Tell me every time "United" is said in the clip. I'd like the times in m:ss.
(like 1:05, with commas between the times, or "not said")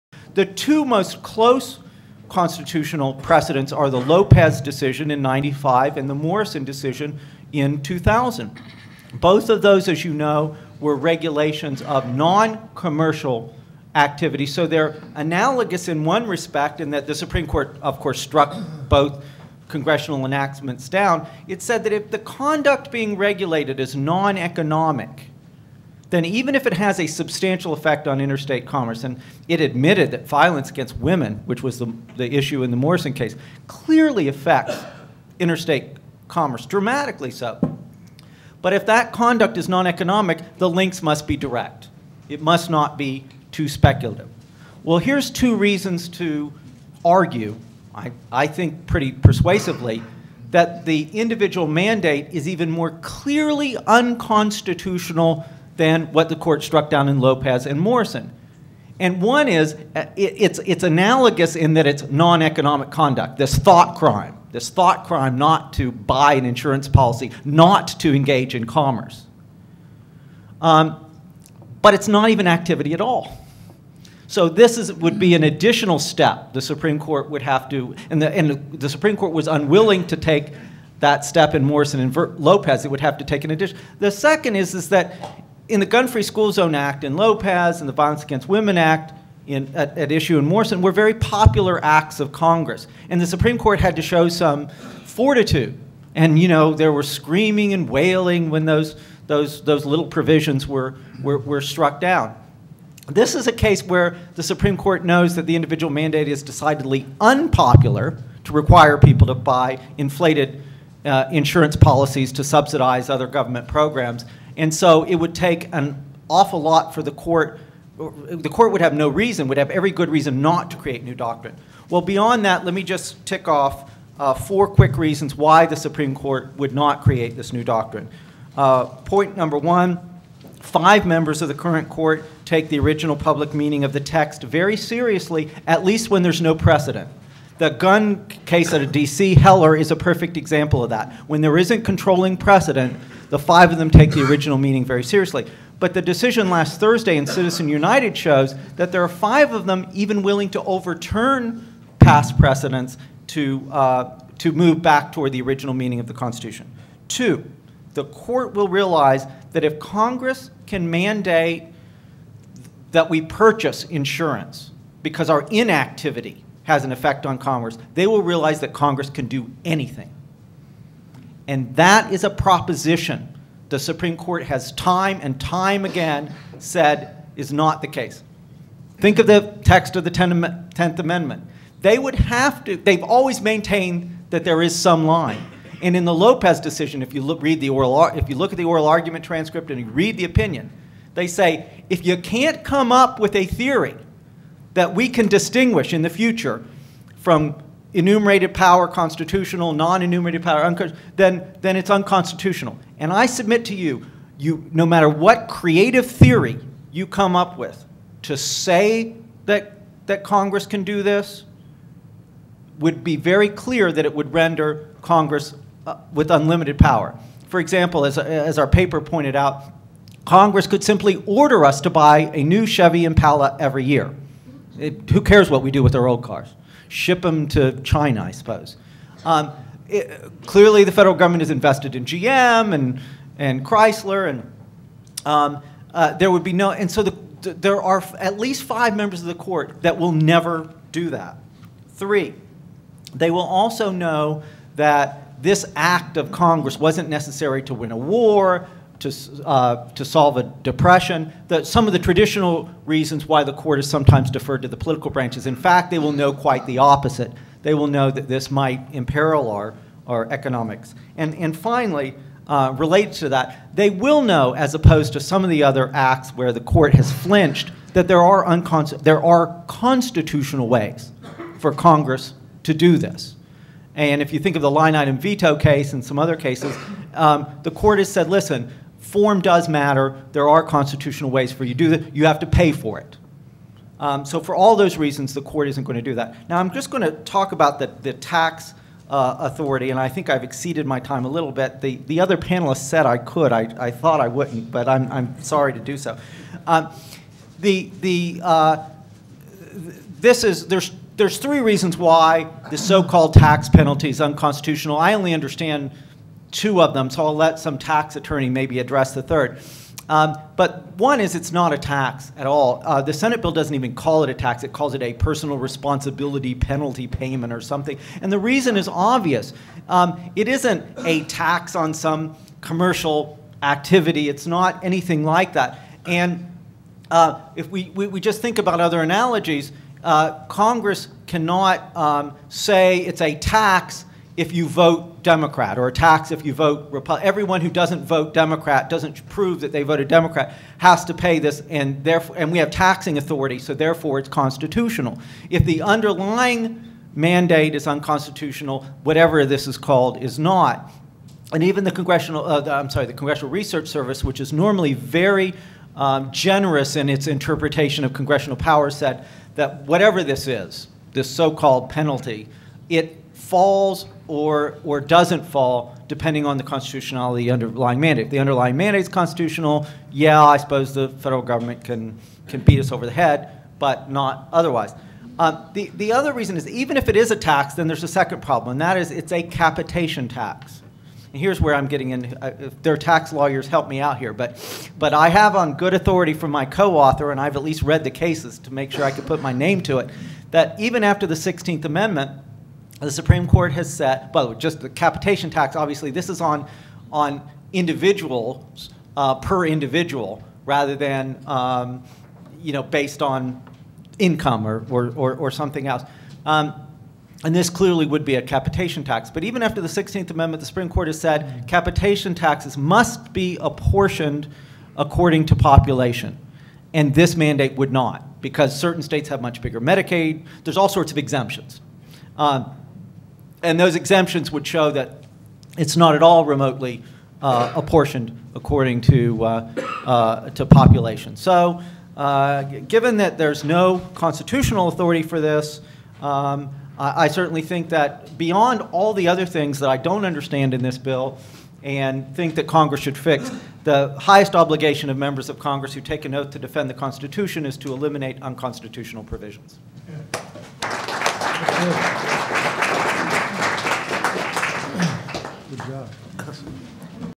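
2:27.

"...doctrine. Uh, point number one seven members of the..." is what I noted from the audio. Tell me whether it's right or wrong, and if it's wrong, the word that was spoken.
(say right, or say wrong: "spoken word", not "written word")
wrong: "five", not "seven".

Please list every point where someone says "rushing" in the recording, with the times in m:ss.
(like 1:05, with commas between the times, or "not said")
not said.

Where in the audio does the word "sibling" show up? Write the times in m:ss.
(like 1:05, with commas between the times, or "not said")
not said.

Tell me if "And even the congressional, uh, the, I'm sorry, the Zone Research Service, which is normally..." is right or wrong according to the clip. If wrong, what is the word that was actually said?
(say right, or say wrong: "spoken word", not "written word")
wrong: "Congressional", not "Zone".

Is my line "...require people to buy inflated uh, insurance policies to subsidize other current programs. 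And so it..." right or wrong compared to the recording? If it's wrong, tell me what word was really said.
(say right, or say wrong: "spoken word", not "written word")
wrong: "government", not "current".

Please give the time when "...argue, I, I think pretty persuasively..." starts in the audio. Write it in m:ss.
0:47.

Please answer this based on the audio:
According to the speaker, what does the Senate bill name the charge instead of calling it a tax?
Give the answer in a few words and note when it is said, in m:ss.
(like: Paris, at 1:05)
personal responsibility penalty payment, at 5:15.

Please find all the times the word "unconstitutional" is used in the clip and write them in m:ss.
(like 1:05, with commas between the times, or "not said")
0:53, 3:21, 5:04, 5:47, 7:28.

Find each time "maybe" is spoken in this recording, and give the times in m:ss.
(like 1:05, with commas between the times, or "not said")
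5:08.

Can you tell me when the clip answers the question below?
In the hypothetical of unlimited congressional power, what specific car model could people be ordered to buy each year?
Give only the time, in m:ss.
3:42.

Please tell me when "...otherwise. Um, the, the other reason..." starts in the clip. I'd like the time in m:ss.
6:14.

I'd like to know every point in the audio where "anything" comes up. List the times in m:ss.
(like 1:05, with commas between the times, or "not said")
2:49, 5:24.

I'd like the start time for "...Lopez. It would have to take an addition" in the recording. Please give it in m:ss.
1:22.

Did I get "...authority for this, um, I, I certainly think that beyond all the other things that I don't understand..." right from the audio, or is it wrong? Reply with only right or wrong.
right.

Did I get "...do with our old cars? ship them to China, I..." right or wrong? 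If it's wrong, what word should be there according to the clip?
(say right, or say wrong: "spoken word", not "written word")
right.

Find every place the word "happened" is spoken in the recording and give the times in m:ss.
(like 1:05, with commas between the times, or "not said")
not said.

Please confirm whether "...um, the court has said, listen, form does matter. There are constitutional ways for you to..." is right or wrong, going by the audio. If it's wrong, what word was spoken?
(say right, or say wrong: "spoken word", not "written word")
right.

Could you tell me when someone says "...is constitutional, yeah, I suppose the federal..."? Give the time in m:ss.
6:09.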